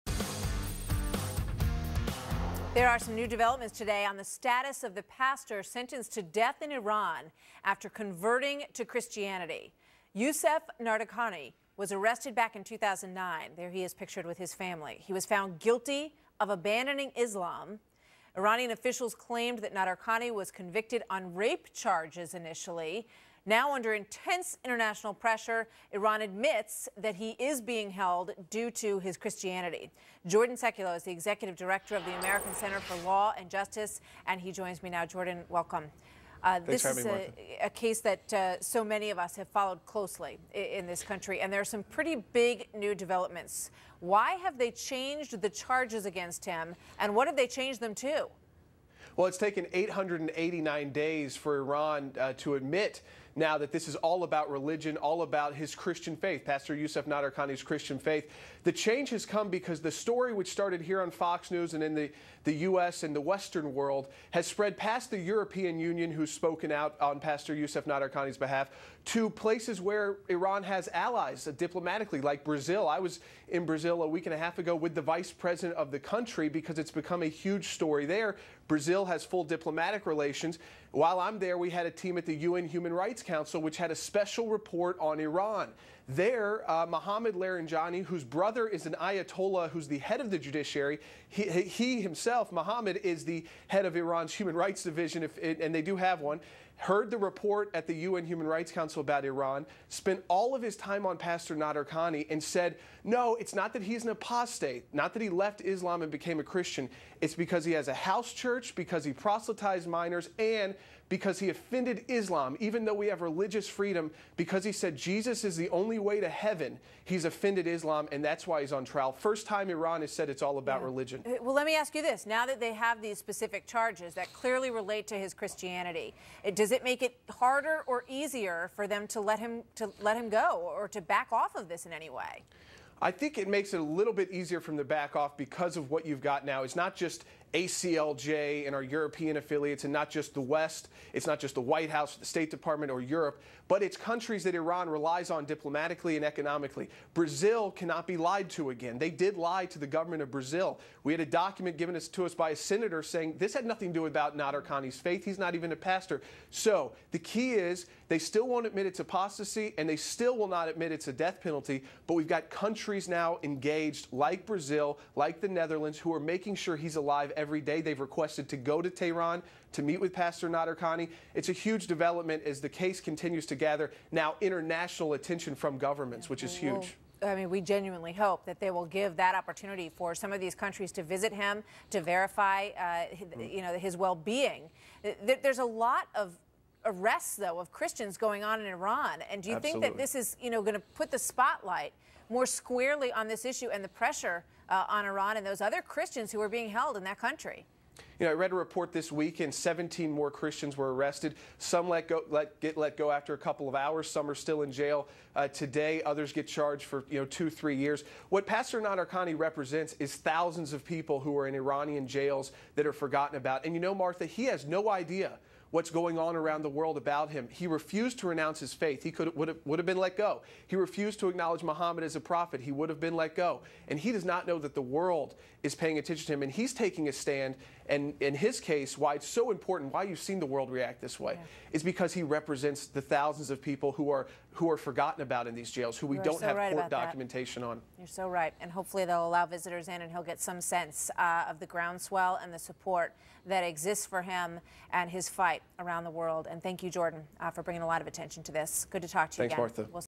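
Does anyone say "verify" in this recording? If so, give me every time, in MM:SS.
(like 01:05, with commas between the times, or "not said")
03:02.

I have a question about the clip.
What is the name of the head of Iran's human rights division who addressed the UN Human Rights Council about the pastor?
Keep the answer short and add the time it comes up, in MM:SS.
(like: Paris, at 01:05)
Mohammad Larijani, at 01:26.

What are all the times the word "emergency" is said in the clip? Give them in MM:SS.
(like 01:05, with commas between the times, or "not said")
not said.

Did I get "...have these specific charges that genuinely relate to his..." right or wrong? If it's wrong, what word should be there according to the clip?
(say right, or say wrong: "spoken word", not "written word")
wrong: "clearly", not "genuinely".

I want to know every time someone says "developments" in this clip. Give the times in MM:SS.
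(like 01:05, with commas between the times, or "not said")
00:03, 00:42, 02:51.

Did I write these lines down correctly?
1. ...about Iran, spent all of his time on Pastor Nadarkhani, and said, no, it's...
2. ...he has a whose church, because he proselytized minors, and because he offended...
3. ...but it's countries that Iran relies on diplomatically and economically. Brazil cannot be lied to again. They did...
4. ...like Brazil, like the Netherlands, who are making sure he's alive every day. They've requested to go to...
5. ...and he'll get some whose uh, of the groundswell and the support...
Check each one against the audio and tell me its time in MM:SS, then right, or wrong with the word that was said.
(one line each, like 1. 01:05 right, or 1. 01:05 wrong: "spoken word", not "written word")
1. 01:39 right
2. 01:47 wrong: "house", not "whose"
3. 02:23 right
4. 02:44 right
5. 04:00 wrong: "sense", not "whose".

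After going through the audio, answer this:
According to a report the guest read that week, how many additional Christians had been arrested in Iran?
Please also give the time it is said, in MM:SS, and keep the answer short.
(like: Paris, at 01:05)
17, at 03:19.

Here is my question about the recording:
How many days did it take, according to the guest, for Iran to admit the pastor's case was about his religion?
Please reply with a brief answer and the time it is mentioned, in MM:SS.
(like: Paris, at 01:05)
889, at 00:49.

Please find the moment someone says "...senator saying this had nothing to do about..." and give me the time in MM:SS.
02:32.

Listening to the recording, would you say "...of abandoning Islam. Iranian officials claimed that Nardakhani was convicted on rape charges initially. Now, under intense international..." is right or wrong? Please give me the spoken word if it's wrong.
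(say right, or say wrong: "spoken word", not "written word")
right.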